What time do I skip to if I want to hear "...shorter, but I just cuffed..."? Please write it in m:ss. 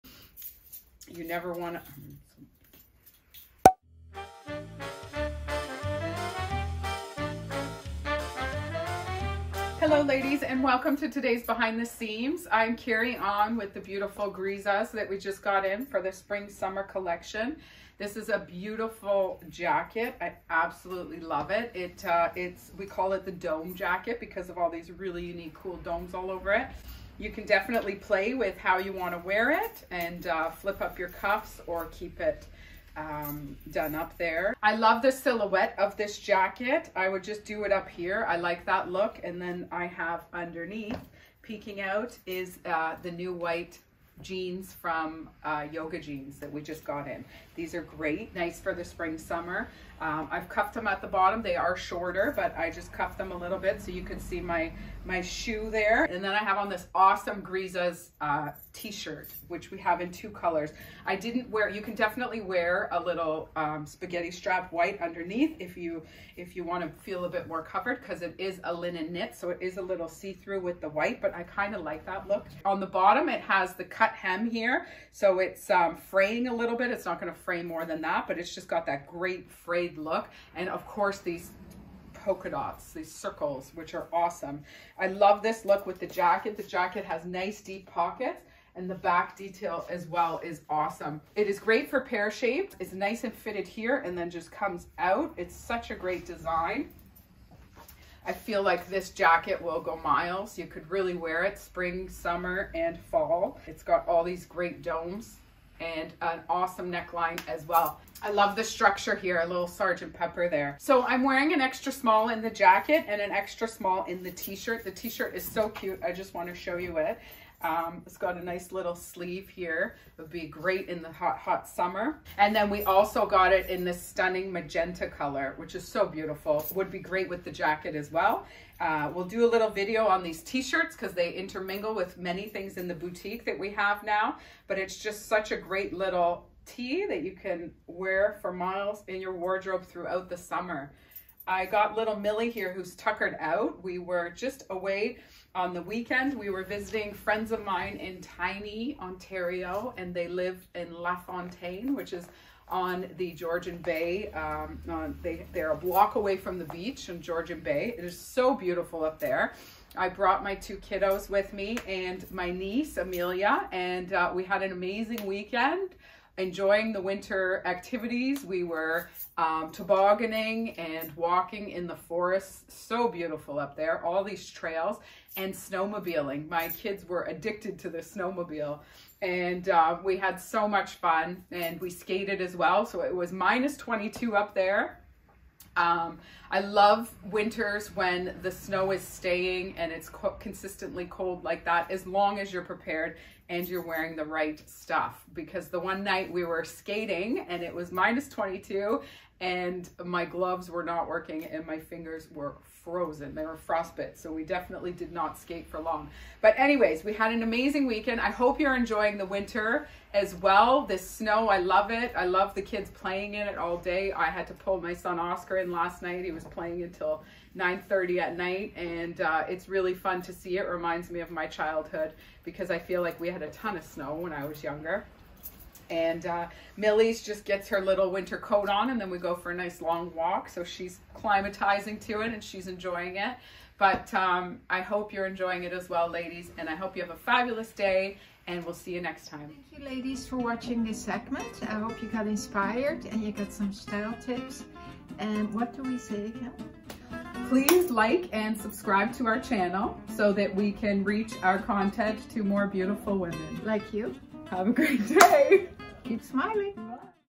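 0:51.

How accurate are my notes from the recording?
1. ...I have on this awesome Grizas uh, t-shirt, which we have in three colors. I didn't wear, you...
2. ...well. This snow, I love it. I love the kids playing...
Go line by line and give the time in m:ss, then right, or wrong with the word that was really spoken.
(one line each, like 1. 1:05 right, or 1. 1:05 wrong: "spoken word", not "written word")
1. 0:56 wrong: "two", not "three"
2. 3:30 right.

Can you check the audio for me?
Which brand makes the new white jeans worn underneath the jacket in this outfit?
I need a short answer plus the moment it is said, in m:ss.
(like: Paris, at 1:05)
Yoga Jeans, at 0:45.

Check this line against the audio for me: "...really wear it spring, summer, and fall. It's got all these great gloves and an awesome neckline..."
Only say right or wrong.
wrong.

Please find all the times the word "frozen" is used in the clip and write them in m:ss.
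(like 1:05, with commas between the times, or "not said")
3:22.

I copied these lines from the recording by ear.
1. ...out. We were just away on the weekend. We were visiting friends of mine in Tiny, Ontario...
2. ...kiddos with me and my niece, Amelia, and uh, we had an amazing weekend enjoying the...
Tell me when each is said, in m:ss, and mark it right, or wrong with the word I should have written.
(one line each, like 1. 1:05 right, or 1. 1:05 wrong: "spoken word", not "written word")
1. 2:23 right
2. 2:40 right.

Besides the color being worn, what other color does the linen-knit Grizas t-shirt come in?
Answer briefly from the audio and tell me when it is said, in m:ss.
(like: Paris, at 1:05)
magenta, at 2:04.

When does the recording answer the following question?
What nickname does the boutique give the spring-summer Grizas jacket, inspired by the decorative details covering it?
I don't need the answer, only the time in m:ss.
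0:23.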